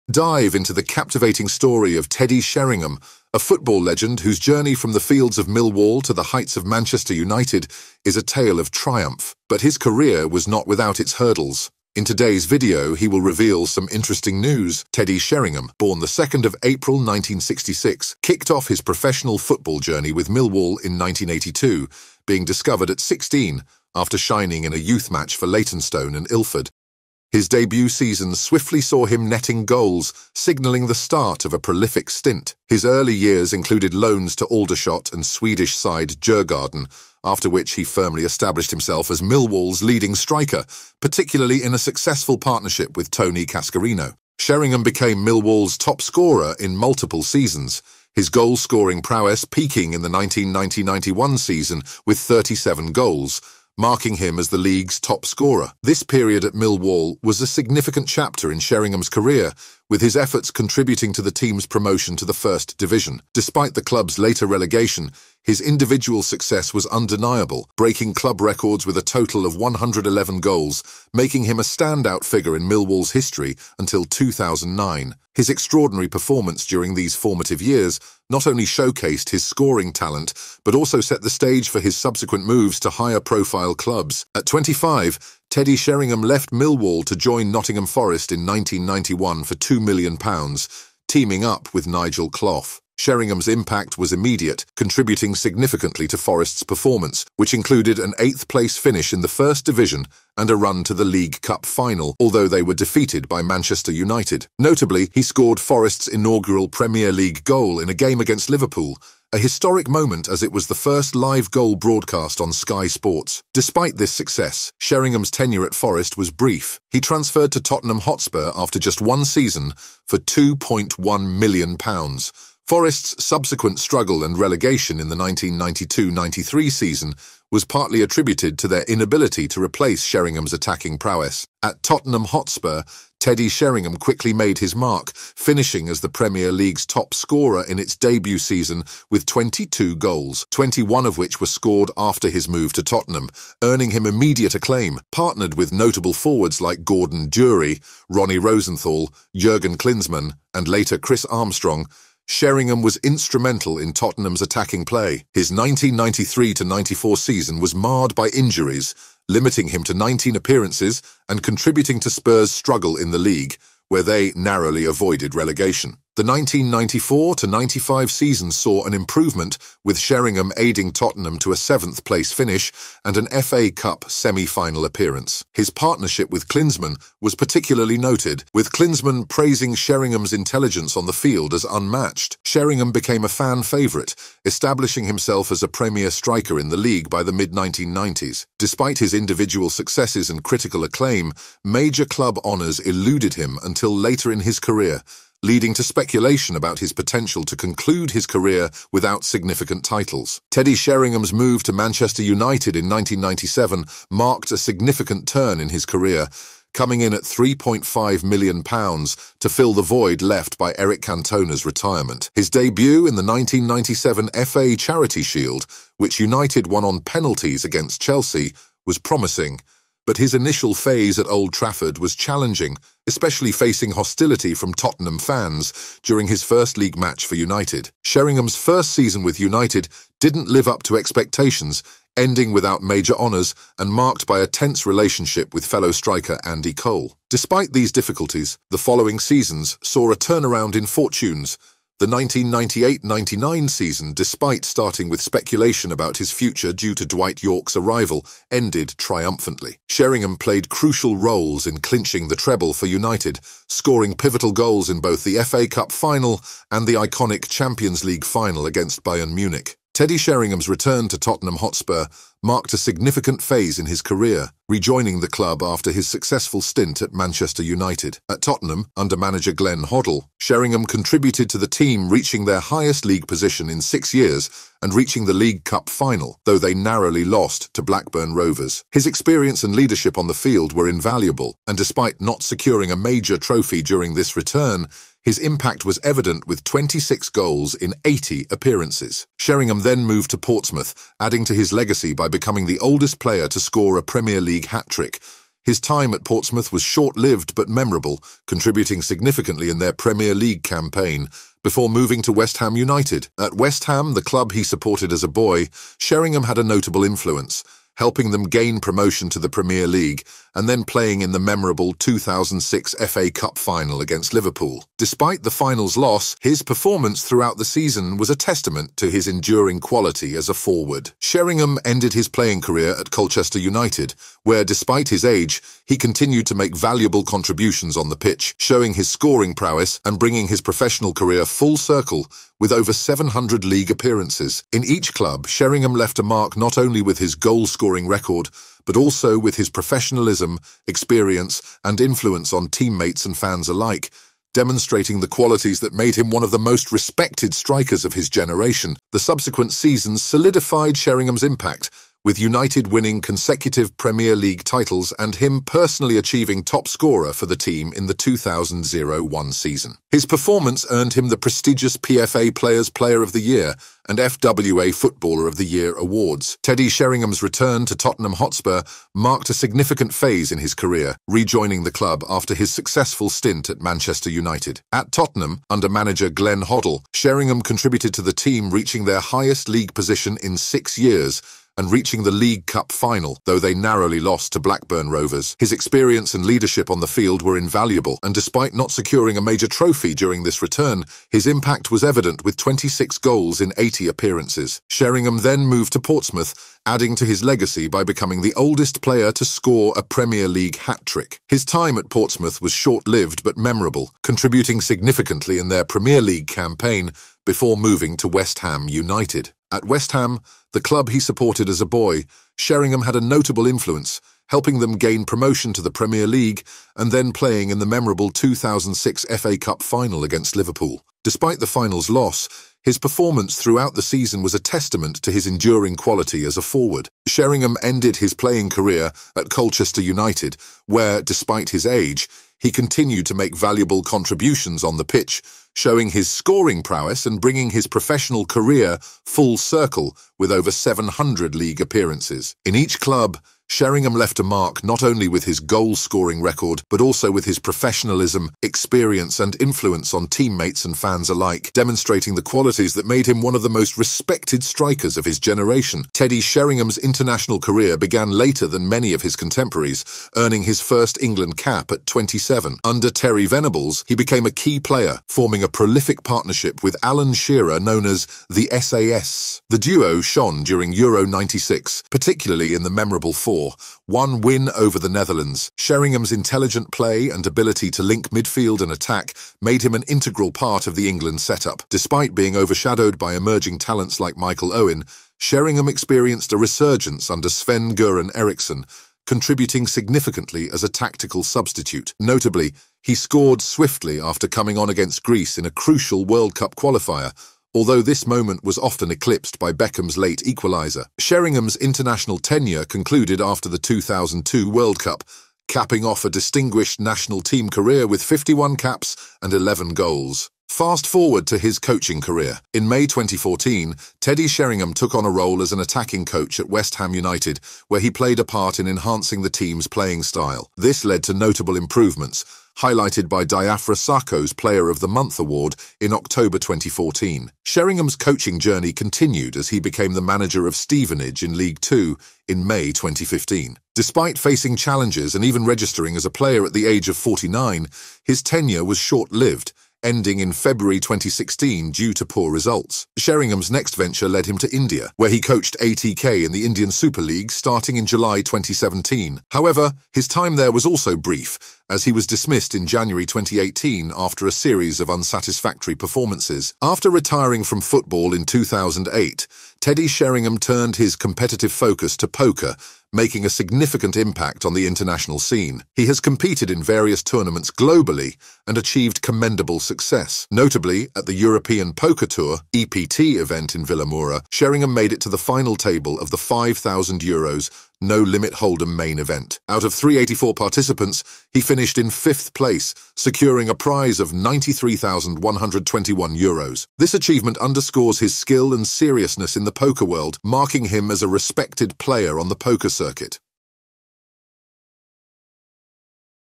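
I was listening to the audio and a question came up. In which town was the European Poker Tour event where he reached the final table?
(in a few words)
Vilamoura.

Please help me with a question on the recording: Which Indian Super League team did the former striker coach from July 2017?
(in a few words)
ATK.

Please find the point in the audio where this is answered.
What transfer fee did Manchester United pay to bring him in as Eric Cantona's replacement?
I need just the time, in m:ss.
3:27.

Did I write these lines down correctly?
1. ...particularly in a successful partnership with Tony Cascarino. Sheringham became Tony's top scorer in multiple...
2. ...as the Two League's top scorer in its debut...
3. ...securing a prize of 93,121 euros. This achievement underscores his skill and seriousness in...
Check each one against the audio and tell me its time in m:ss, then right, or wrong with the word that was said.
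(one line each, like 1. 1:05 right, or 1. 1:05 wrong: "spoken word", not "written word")
1. 0:40 wrong: "Millwall", not "Tony"
2. 2:15 wrong: "Premier", not "Two"
3. 9:43 right.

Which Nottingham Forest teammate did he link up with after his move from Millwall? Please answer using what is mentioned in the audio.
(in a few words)
Nigel Clough.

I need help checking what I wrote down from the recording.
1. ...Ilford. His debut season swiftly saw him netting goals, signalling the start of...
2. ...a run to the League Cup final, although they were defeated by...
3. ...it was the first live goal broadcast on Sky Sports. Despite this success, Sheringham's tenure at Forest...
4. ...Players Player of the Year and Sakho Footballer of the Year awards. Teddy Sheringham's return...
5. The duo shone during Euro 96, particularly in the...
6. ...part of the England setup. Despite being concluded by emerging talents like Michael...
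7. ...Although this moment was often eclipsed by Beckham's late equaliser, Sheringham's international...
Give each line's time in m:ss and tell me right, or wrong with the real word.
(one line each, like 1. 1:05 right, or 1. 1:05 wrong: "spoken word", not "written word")
1. 0:26 right
2. 1:40 right
3. 1:50 right
4. 6:02 wrong: "FWA", not "Sakho"
5. 7:49 right
6. 8:00 wrong: "overshadowed", not "concluded"
7. 8:17 right.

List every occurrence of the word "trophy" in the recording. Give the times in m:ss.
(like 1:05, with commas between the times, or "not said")
4:43, 6:29.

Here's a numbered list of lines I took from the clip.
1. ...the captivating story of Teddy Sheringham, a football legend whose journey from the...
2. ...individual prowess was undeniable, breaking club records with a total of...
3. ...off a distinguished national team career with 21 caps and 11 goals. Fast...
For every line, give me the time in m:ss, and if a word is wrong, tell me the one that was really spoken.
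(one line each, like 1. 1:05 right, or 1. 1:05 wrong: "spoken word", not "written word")
1. 0:00 right
2. 1:05 wrong: "success", not "prowess"
3. 8:26 wrong: "51", not "21".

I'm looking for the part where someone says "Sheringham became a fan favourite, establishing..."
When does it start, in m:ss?
3:02.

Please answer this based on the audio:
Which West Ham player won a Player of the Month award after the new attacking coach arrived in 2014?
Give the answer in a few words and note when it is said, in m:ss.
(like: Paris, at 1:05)
Diafra Sakho, at 8:43.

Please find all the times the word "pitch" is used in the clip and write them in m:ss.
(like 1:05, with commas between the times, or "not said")
5:28, 7:15.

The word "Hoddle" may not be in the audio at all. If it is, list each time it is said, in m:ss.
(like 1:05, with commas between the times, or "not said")
4:29, 6:16.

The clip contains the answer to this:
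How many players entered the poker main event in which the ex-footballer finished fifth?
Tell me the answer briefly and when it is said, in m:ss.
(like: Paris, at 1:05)
384, at 9:39.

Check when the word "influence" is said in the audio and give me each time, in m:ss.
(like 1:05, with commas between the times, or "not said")
5:07, 5:41, 6:53, 7:29.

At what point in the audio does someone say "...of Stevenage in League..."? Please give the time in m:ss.
8:50.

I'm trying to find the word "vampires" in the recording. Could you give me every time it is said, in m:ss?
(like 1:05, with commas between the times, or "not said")
not said.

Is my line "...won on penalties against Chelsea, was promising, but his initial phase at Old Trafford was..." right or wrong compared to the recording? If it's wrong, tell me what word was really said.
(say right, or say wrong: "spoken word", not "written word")
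right.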